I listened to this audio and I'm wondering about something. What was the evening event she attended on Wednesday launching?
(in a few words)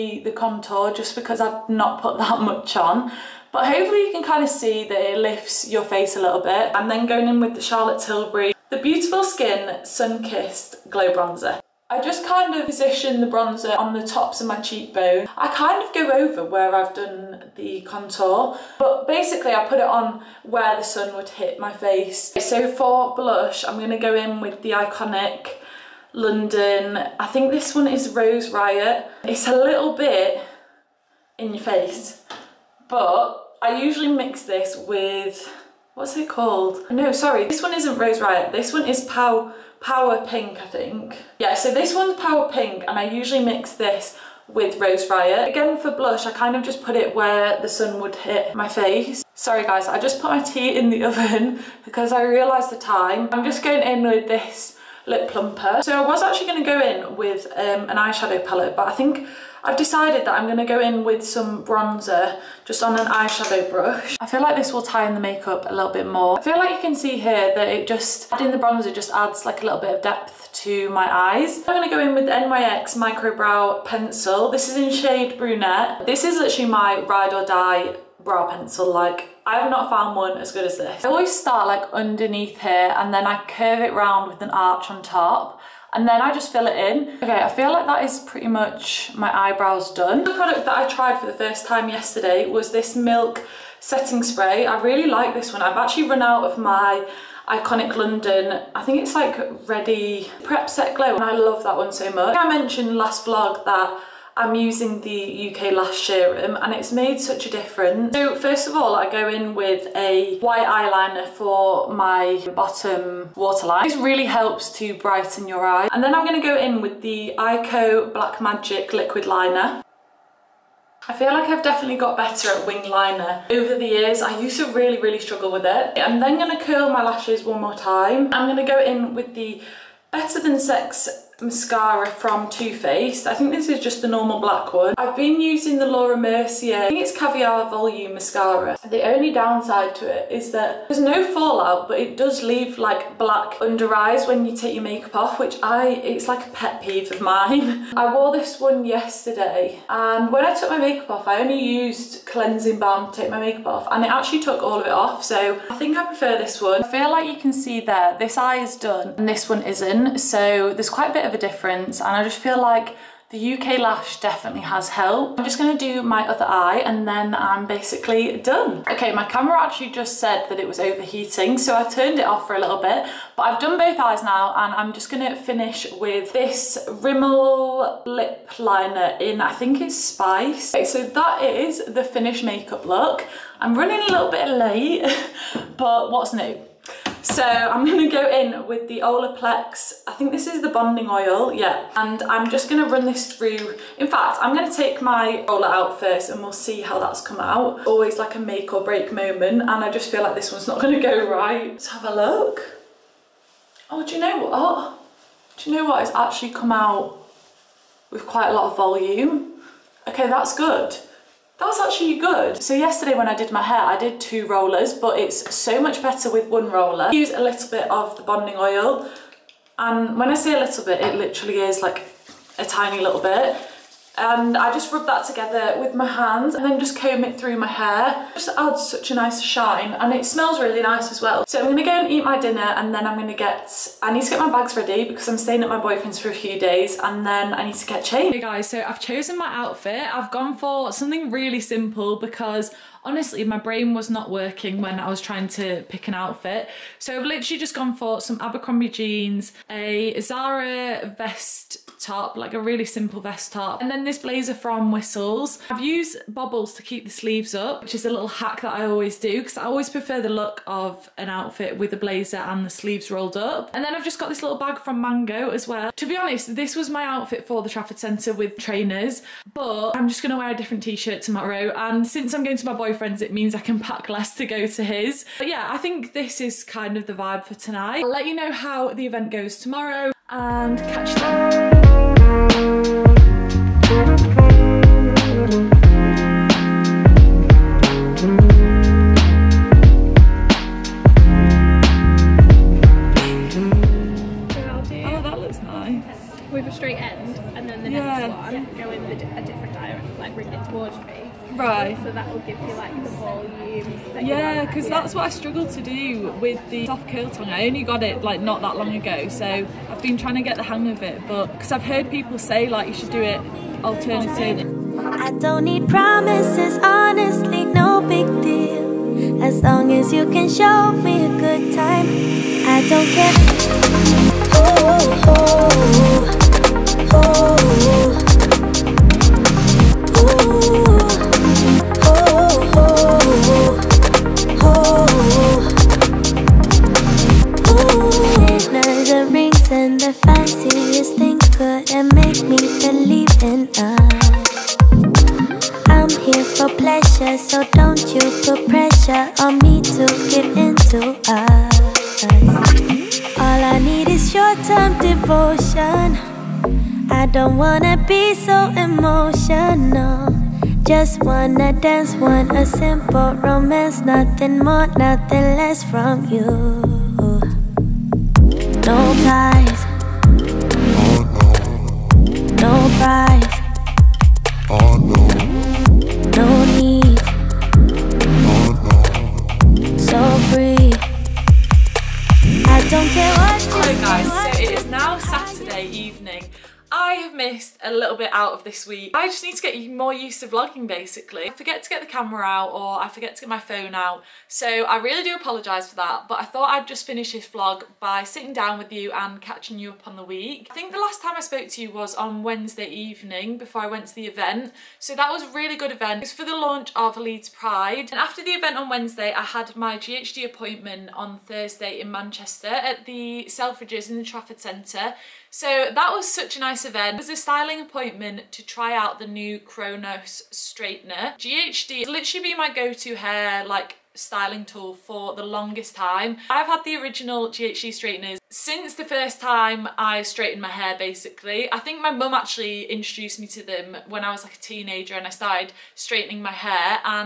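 Leeds Pride.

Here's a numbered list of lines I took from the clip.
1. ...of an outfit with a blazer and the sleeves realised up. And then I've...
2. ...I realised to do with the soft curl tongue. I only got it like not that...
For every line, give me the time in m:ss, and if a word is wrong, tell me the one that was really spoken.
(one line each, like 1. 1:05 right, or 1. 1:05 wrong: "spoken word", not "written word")
1. 4:20 wrong: "rolled", not "realised"
2. 5:05 wrong: "struggled", not "realised".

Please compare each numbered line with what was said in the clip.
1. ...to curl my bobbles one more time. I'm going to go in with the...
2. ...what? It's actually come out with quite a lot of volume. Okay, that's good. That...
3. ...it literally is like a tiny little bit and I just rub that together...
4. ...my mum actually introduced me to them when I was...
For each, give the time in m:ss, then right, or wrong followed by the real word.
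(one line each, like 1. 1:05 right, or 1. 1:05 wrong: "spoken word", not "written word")
1. 2:06 wrong: "lashes", not "bobbles"
2. 3:25 right
3. 3:40 right
4. 7:12 right.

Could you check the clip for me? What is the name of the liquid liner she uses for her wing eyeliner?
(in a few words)
Eyeko Black Magic.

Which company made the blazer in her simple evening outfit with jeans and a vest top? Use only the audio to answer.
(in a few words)
Whistles.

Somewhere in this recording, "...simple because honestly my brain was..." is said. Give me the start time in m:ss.
4:01.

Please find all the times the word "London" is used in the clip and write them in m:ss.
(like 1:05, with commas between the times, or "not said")
0:26, 1:37.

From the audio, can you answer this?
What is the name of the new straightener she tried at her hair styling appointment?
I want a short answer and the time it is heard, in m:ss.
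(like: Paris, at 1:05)
Chronos, at 6:59.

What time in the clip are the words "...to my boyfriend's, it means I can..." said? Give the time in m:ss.
4:32.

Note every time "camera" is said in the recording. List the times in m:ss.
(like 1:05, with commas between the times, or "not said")
2:49, 6:32.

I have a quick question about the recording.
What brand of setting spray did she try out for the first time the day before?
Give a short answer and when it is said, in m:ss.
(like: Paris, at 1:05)
Milk, at 1:32.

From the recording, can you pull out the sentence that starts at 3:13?
In fact, I'm gonna take my roller out first and we'll see how that's come out.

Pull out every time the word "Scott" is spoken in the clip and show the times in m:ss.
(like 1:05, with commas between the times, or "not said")
not said.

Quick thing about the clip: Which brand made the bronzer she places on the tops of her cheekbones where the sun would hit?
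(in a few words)
Charlotte Tilbury.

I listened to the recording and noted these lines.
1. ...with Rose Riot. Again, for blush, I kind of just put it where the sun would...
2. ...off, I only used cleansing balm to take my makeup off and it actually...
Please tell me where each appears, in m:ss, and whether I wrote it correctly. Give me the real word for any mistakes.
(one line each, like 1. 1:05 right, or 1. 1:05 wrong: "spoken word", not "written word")
1. 0:44 right
2. 2:31 right.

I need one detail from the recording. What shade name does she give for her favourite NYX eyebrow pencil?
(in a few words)
Brunette.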